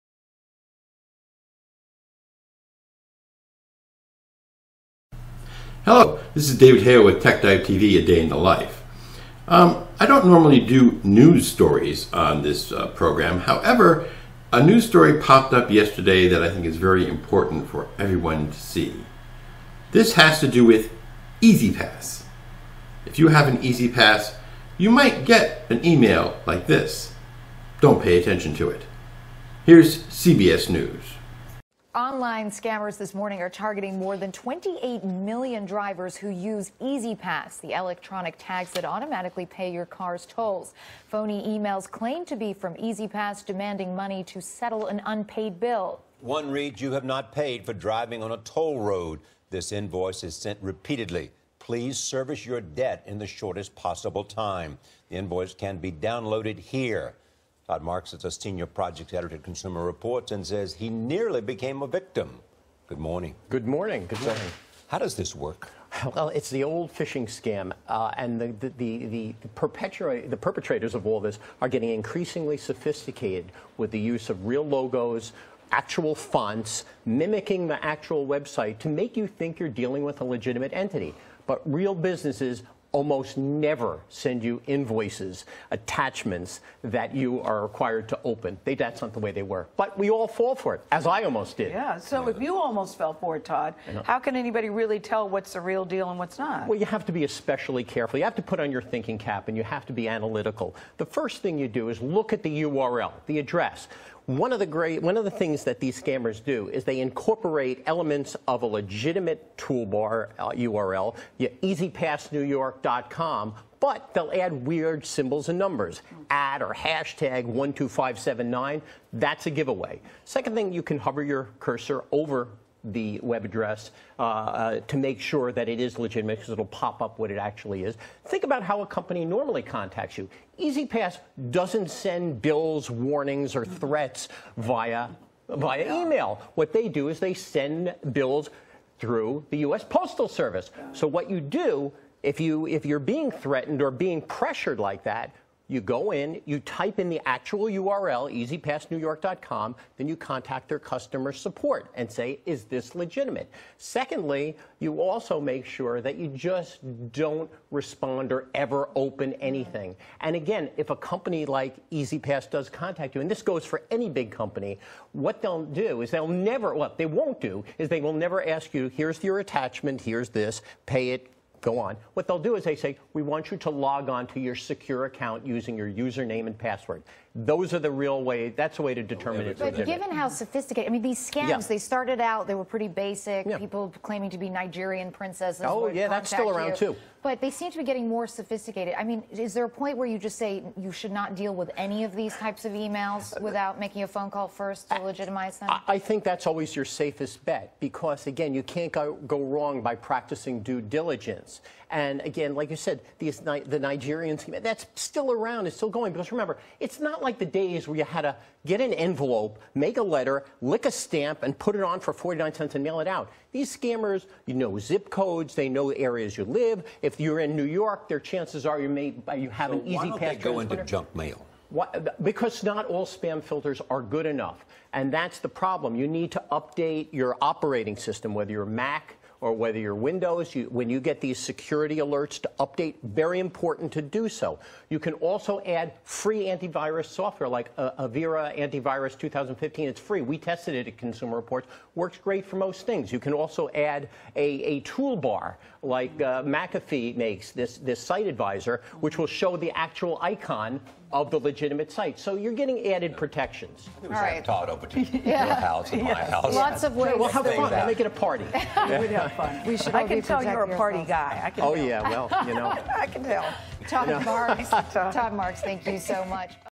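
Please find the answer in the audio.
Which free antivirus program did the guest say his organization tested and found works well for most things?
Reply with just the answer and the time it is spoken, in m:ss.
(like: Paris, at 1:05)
Avira Antivirus 2015, at 3:58.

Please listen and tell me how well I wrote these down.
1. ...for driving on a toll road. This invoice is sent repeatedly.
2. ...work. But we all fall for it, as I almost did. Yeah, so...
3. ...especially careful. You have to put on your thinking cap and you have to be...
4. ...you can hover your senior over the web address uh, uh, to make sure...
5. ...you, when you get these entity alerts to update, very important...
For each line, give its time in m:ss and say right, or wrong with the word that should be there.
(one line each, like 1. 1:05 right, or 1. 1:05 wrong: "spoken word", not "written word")
1. 0:47 right
2. 1:29 right
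3. 1:37 right
4. 2:00 wrong: "cursor", not "senior"
5. 3:50 wrong: "security", not "entity".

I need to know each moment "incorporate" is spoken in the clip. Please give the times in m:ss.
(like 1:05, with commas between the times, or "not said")
1:47.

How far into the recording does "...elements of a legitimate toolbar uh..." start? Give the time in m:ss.
1:47.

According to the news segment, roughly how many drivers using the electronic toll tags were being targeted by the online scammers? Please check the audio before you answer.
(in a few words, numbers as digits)
28 million.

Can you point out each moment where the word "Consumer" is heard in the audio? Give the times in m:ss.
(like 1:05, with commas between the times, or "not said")
0:59, 4:00.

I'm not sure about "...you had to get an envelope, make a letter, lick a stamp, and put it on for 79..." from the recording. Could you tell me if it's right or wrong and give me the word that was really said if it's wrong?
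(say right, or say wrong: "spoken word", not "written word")
wrong: "49", not "79".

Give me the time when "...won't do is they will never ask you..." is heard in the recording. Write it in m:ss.
2:47.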